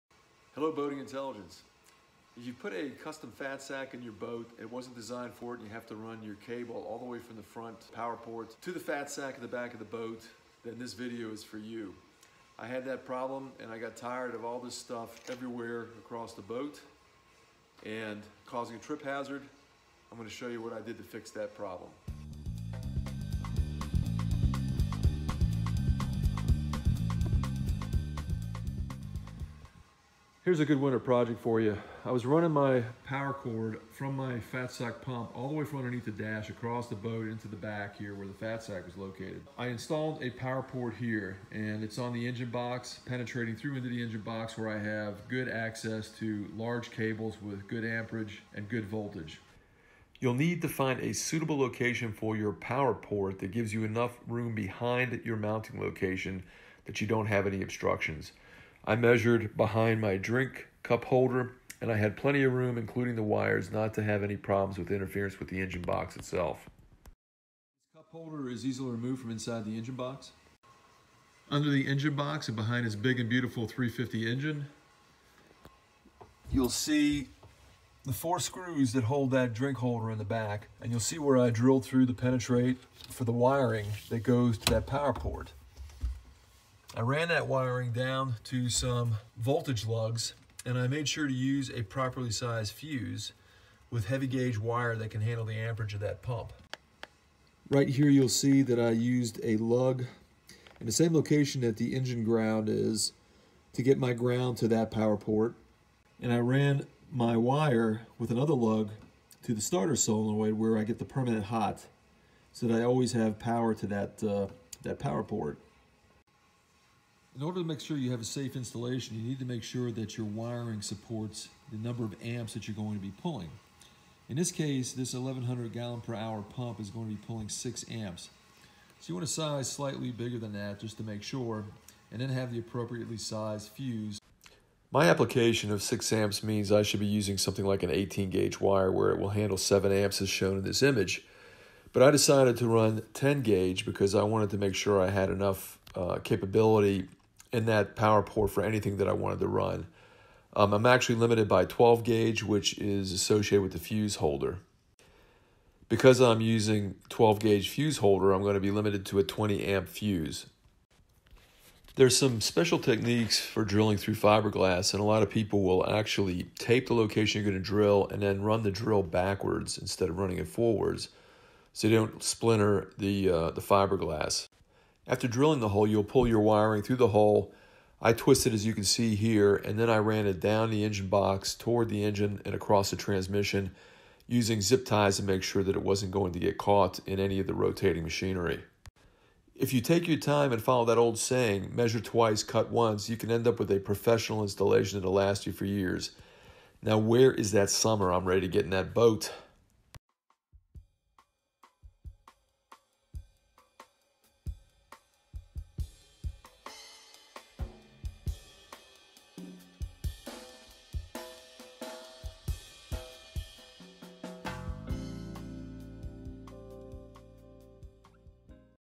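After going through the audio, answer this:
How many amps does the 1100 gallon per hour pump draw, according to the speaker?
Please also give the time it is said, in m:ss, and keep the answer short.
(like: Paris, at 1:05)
6 amps, at 2:07.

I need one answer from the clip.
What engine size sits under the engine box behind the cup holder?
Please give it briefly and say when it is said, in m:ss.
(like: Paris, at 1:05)
350, at 1:13.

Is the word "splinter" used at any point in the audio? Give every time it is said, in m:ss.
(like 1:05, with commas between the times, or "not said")
2:52.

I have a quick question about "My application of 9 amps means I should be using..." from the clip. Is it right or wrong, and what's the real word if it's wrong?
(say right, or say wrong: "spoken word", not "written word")
wrong: "6", not "9".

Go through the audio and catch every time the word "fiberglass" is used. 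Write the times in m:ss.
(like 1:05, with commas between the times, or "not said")
2:44, 2:53.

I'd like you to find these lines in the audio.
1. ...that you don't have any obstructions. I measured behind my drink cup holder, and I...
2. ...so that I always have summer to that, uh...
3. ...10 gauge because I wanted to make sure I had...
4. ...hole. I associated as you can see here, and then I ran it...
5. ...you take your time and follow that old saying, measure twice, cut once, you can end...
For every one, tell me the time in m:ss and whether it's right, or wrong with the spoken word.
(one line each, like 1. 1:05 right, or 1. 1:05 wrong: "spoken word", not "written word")
1. 0:56 right
2. 1:52 wrong: "power", not "summer"
3. 2:23 right
4. 2:57 wrong: "twisted", not "associated"
5. 3:09 right.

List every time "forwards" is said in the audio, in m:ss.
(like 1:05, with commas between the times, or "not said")
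2:50.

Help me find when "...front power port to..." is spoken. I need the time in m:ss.
0:07.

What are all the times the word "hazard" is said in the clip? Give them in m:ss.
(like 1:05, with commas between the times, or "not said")
0:19.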